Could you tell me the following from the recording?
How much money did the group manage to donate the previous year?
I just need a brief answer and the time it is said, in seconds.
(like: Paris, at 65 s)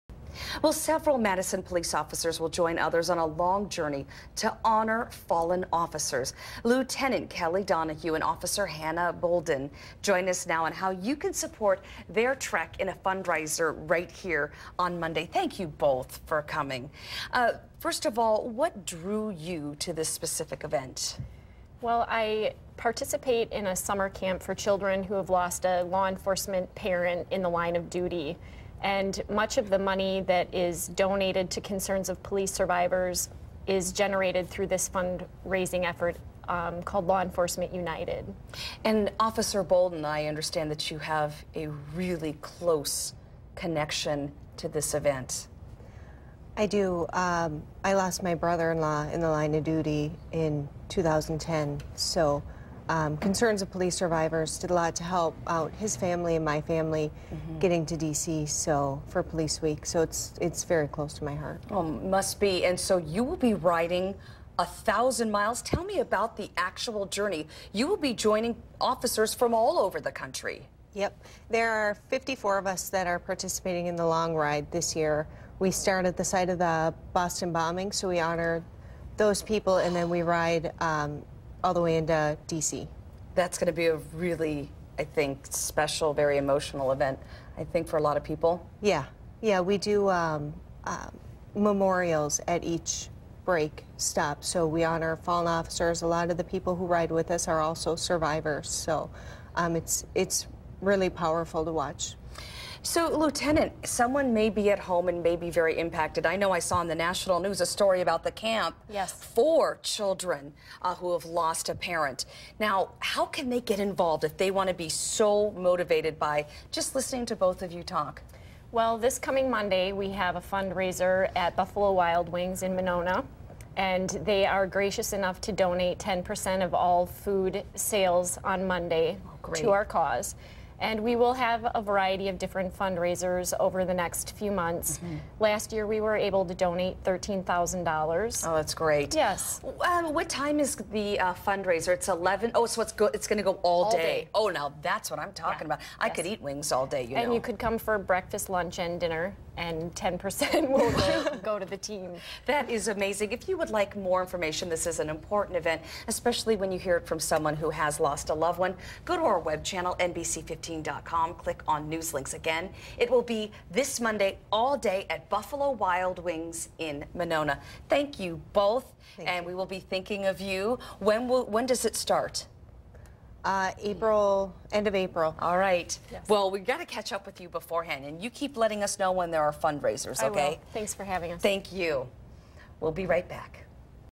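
$13,000, at 137 s.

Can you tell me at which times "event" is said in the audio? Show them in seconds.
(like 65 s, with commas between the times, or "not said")
20 s, 44 s, 86 s, 155 s.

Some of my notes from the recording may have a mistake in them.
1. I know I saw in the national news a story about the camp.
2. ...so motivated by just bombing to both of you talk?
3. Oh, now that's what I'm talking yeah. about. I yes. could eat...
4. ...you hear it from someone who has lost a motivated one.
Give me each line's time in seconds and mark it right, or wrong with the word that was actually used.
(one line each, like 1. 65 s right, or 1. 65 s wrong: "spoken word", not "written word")
1. 106 s right
2. 114 s wrong: "listening", not "bombing"
3. 144 s right
4. 156 s wrong: "loved", not "motivated".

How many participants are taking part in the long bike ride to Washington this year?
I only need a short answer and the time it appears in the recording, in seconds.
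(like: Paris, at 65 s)
54, at 72 s.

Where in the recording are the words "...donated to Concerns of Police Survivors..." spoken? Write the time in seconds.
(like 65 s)
30 s.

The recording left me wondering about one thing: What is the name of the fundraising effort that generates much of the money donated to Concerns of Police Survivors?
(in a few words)
Law Enforcement United.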